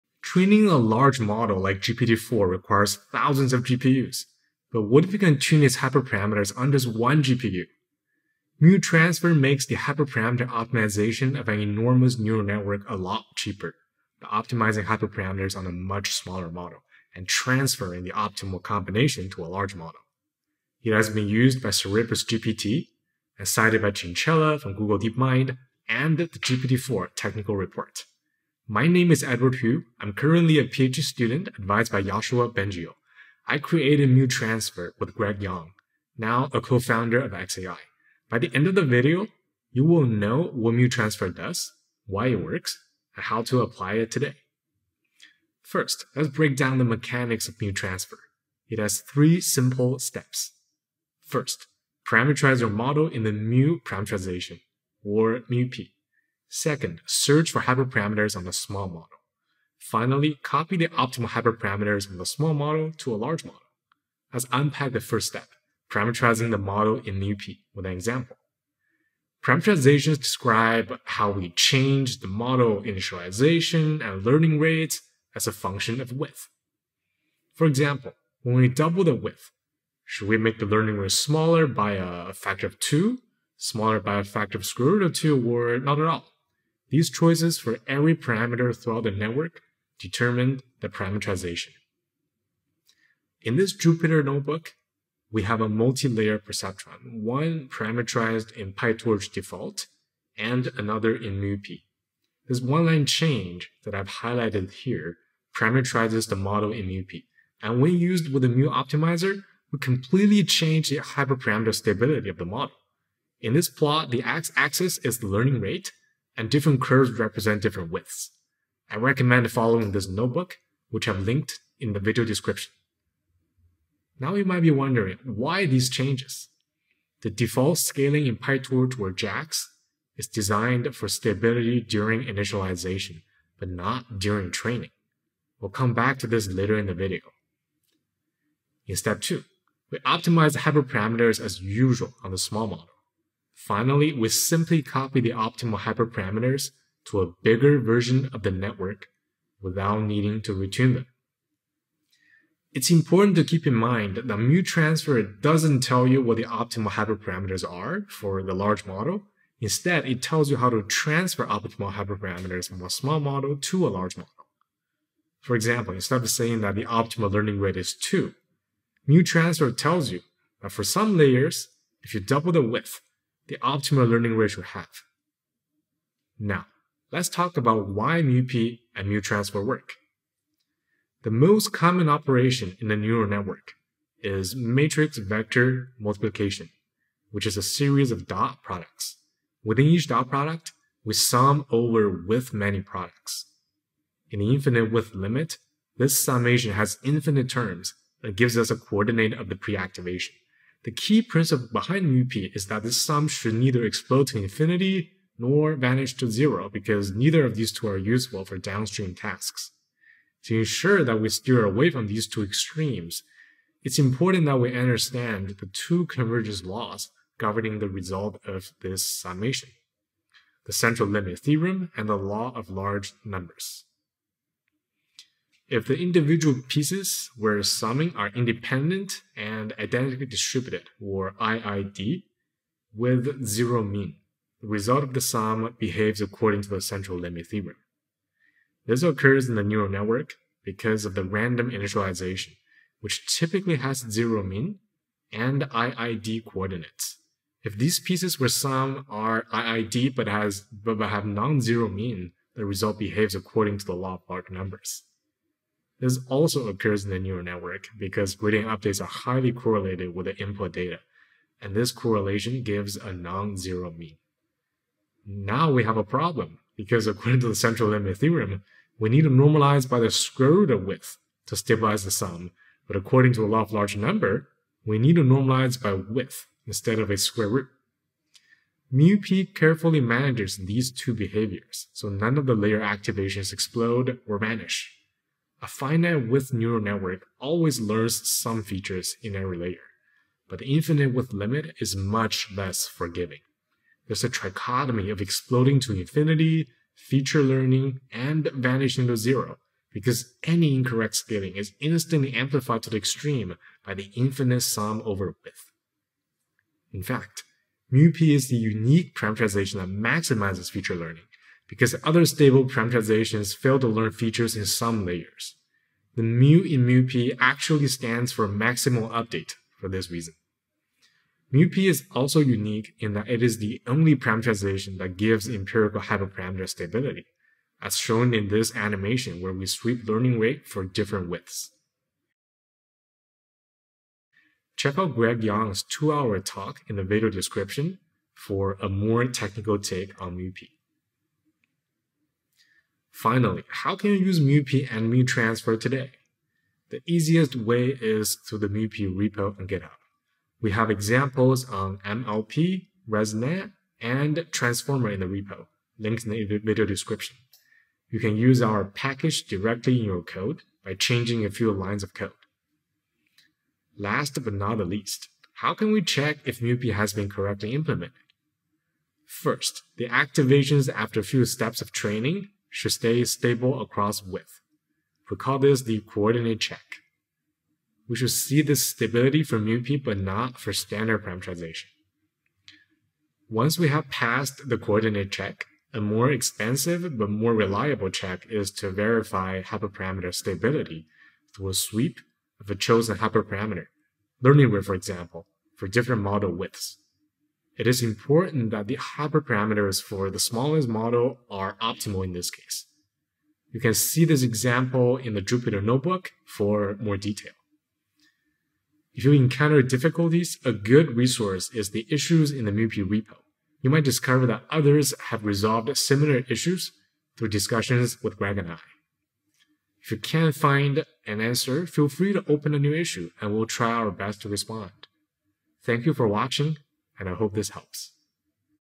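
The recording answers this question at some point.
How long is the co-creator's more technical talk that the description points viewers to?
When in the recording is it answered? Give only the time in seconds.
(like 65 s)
335 s.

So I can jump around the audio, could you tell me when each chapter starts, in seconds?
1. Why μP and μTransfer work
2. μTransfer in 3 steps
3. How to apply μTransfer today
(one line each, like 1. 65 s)
1. 180 s
2. 45 s
3. 342 s.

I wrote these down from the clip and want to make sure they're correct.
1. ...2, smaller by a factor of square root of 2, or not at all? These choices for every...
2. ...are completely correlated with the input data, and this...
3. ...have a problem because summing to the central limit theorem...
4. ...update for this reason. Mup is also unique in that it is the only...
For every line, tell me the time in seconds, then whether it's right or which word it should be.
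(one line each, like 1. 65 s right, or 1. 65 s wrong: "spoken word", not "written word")
1. 82 s right
2. 258 s wrong: "highly", not "completely"
3. 265 s wrong: "according", not "summing"
4. 319 s right.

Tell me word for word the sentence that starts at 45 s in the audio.
First, let's break down the mechanics of Mu Transfer.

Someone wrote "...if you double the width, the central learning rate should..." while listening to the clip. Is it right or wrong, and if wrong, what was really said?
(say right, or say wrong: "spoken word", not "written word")
wrong: "optimal", not "central".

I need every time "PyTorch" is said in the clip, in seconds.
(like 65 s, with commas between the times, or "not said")
98 s, 128 s.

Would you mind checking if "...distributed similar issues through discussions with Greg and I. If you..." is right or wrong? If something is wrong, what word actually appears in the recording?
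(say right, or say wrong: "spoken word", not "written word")
wrong: "resolved", not "distributed".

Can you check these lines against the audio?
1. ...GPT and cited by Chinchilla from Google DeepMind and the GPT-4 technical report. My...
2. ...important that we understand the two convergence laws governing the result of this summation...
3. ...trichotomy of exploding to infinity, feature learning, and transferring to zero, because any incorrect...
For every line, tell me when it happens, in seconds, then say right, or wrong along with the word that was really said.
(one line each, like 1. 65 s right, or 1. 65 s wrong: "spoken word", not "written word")
1. 22 s right
2. 213 s right
3. 294 s wrong: "vanishing", not "transferring".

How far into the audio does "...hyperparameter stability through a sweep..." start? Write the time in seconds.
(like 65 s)
389 s.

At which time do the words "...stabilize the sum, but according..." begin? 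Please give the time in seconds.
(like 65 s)
271 s.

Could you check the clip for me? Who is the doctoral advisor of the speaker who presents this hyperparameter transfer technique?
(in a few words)
Yoshua Bengio.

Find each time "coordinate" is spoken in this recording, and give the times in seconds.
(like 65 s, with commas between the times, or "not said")
198 s, 246 s, 375 s, 384 s.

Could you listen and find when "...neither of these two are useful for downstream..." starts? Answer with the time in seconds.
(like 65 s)
207 s.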